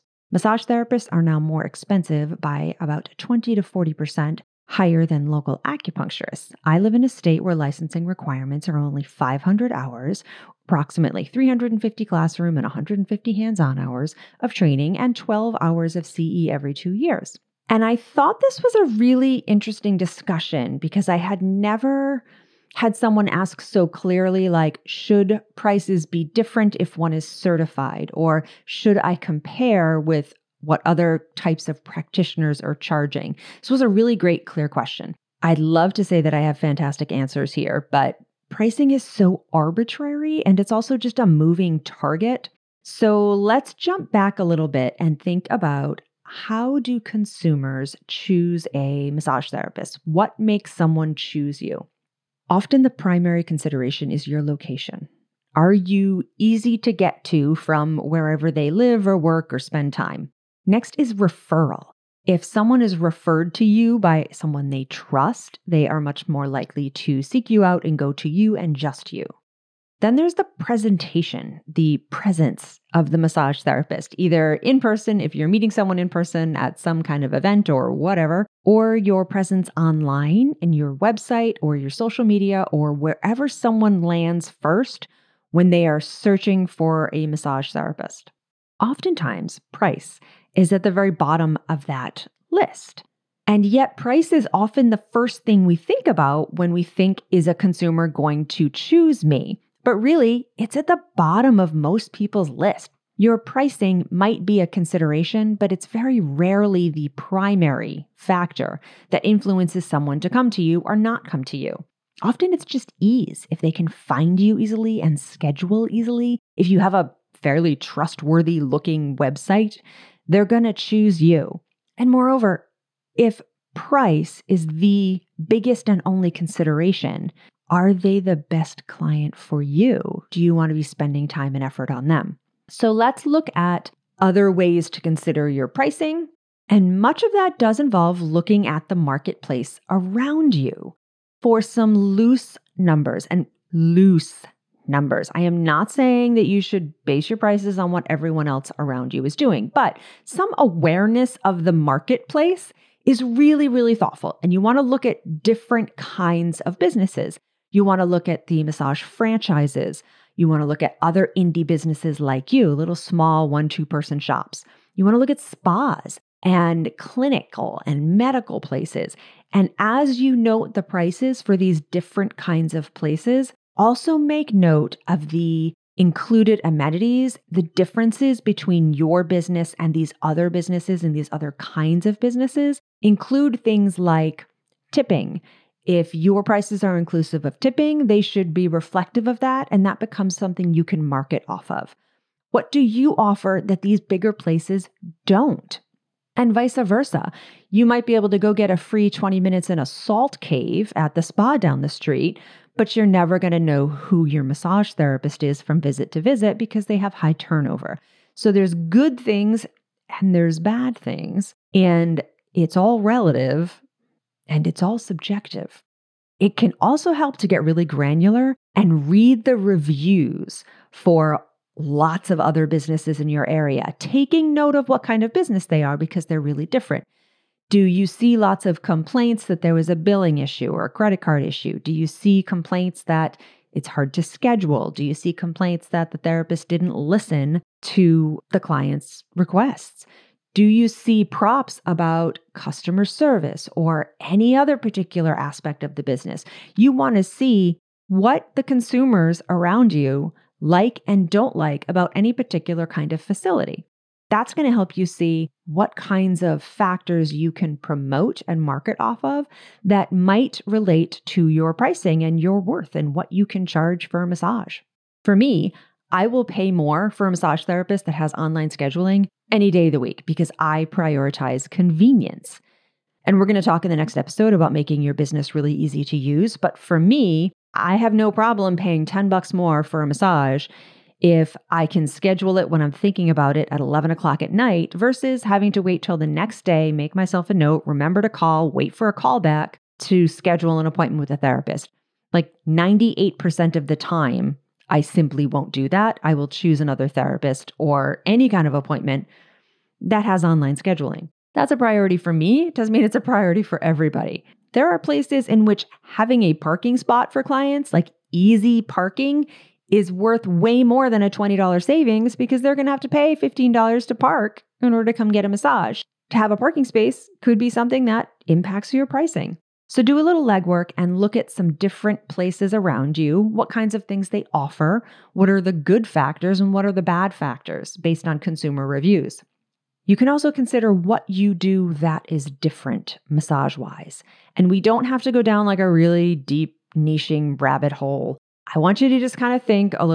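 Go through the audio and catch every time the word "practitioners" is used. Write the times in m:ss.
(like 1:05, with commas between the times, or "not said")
0:31.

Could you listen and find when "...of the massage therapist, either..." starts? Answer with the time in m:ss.
1:12.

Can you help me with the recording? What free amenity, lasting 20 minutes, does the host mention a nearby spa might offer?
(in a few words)
salt cave.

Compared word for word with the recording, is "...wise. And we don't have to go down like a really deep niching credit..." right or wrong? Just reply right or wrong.
wrong.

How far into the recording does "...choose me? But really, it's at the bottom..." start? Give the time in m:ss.
1:38.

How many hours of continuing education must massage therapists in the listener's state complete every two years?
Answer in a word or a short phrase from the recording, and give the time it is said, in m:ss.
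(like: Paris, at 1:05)
12 hours, at 0:15.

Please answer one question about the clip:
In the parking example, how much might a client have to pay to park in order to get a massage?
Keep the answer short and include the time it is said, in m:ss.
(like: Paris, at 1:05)
$15, at 5:13.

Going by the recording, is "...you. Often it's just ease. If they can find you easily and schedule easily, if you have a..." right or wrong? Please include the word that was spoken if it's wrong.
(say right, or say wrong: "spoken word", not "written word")
right.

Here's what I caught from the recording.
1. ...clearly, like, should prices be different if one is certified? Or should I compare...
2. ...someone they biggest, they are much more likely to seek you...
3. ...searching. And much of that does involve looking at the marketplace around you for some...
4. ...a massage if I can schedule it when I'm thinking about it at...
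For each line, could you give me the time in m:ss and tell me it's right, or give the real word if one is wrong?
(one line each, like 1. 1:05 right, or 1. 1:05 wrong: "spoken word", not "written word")
1. 0:23 right
2. 1:04 wrong: "trust", not "biggest"
3. 2:15 wrong: "pricing", not "searching"
4. 4:40 right.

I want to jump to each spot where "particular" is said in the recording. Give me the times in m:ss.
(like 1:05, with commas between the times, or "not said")
4:04, 4:12.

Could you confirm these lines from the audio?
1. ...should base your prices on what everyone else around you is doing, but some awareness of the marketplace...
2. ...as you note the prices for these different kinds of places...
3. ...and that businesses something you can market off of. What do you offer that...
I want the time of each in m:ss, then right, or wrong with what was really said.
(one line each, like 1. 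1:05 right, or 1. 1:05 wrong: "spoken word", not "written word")
1. 2:26 right
2. 2:49 right
3. 3:09 wrong: "becomes", not "businesses".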